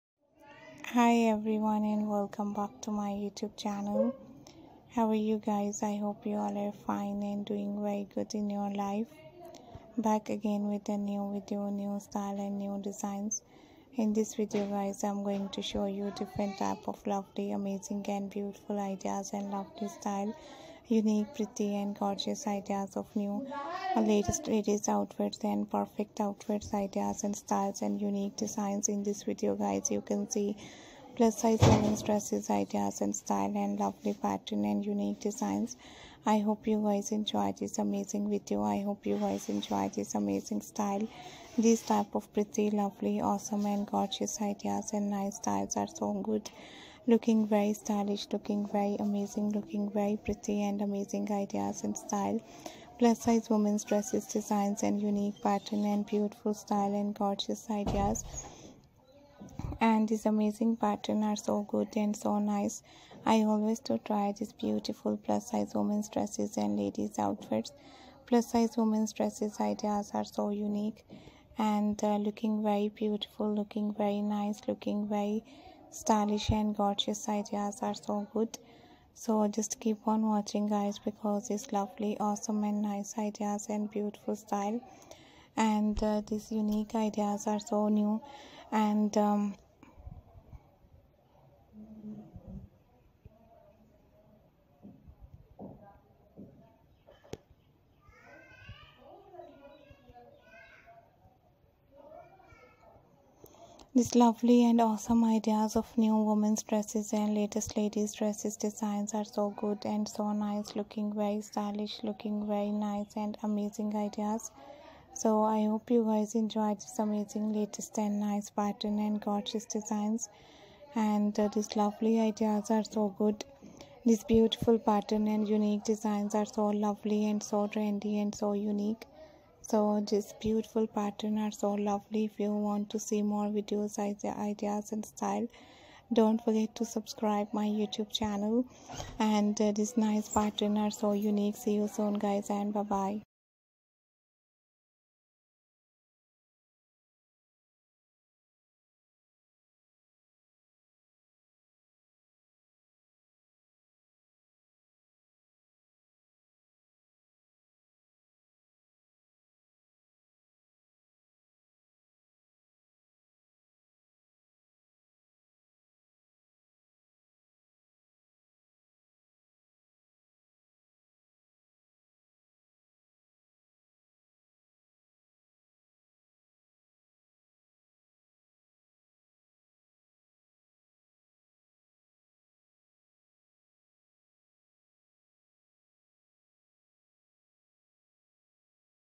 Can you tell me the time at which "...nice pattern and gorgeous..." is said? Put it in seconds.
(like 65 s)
118 s.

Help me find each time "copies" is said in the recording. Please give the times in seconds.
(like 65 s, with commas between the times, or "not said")
not said.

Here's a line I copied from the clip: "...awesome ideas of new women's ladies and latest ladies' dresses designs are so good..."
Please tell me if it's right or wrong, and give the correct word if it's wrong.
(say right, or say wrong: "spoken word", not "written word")
wrong: "dresses", not "ladies".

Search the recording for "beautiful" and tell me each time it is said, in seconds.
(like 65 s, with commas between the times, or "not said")
18 s, 56 s, 64 s, 72 s, 83 s, 124 s, 130 s.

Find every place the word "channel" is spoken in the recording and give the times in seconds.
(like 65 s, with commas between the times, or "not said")
3 s, 138 s.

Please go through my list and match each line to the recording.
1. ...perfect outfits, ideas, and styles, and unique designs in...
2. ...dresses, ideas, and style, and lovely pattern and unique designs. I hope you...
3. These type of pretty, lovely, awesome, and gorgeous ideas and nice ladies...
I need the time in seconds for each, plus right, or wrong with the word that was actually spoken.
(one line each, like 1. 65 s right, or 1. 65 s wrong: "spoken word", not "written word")
1. 25 s right
2. 32 s right
3. 41 s wrong: "styles", not "ladies".